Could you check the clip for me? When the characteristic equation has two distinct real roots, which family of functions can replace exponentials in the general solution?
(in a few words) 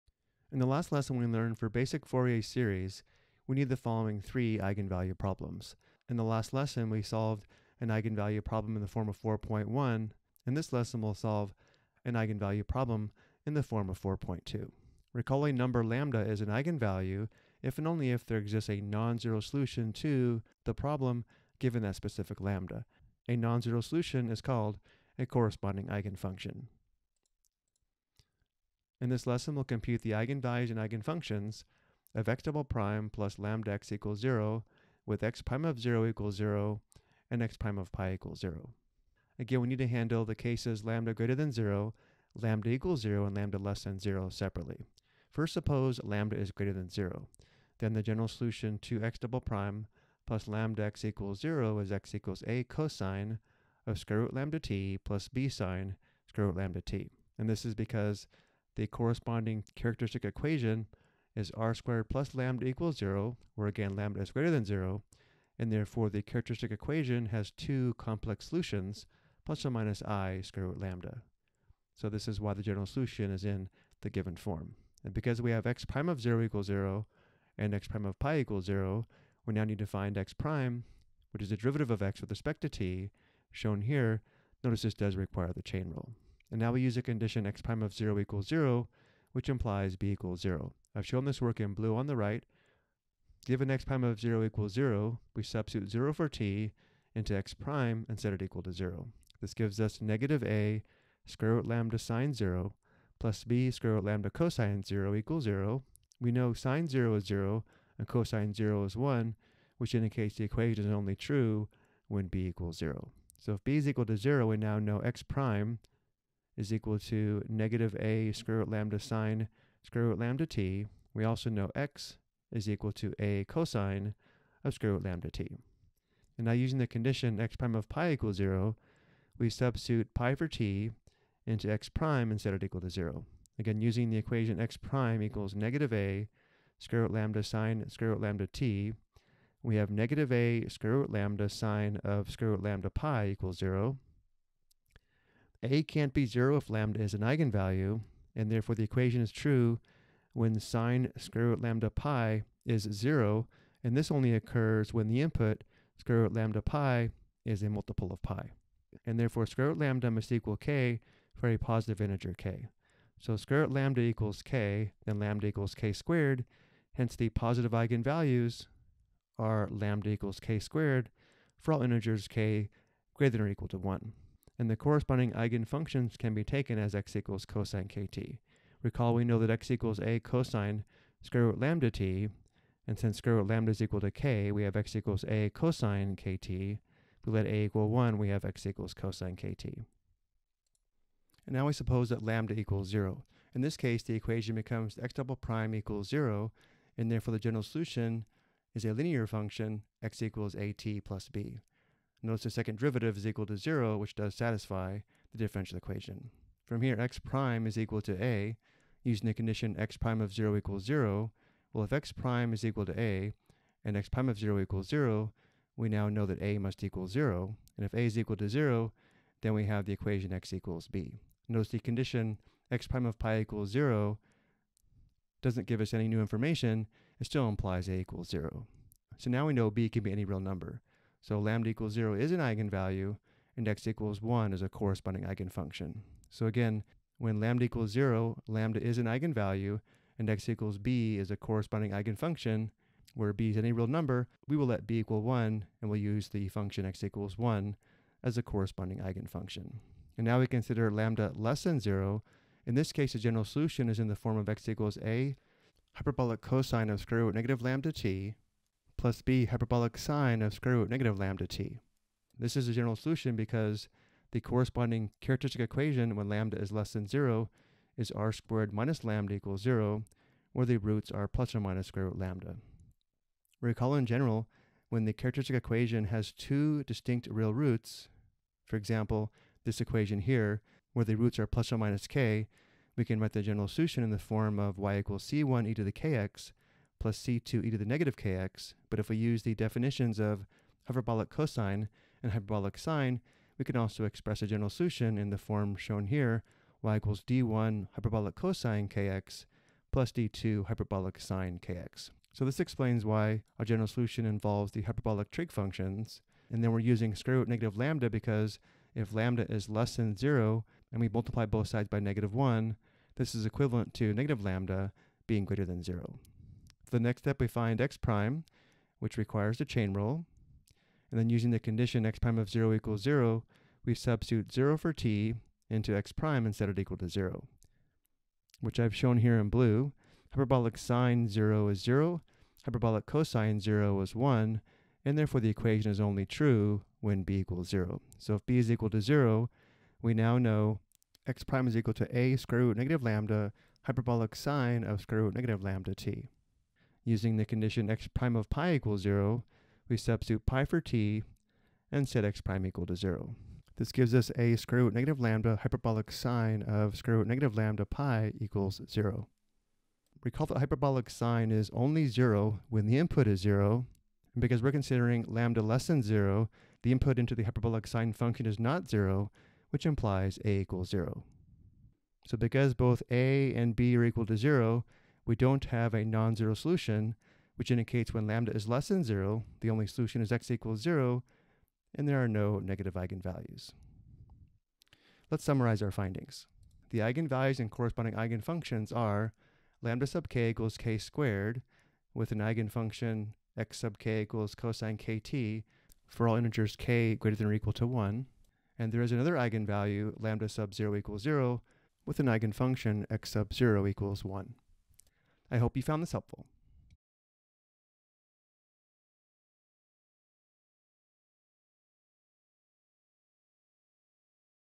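hyperbolic trig functions.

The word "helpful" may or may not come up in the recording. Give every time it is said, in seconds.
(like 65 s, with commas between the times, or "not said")
406 s.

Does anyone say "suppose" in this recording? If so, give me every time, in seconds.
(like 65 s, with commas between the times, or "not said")
45 s, 191 s.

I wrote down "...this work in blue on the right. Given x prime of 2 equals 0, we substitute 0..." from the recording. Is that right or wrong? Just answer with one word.
wrong.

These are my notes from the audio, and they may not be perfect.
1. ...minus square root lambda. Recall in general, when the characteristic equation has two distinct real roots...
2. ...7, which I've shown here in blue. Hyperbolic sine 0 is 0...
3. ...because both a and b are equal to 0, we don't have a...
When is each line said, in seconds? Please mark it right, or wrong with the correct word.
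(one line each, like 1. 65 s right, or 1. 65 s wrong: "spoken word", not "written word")
1. 271 s right
2. 327 s wrong: "0", not "7"
3. 372 s right.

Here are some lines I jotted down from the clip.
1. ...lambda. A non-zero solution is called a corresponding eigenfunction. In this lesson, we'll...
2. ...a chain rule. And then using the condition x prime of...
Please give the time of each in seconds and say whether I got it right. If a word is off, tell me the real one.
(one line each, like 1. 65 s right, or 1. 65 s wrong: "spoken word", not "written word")
1. 22 s right
2. 319 s right.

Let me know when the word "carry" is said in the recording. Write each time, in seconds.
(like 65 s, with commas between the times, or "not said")
not said.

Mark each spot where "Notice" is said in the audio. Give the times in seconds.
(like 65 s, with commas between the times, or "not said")
84 s, 202 s, 221 s.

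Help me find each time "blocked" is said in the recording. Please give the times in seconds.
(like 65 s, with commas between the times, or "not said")
not said.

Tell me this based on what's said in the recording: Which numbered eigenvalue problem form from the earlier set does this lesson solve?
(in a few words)
4.2.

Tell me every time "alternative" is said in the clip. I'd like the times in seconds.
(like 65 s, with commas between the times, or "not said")
not said.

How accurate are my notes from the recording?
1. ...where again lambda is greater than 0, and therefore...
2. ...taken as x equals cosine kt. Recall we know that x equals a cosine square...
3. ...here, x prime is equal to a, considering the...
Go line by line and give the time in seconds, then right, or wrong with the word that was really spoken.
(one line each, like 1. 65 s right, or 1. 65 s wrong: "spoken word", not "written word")
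1. 63 s right
2. 176 s right
3. 206 s wrong: "using", not "considering".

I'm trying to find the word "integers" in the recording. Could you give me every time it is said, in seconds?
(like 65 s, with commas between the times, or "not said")
162 s, 171 s, 396 s.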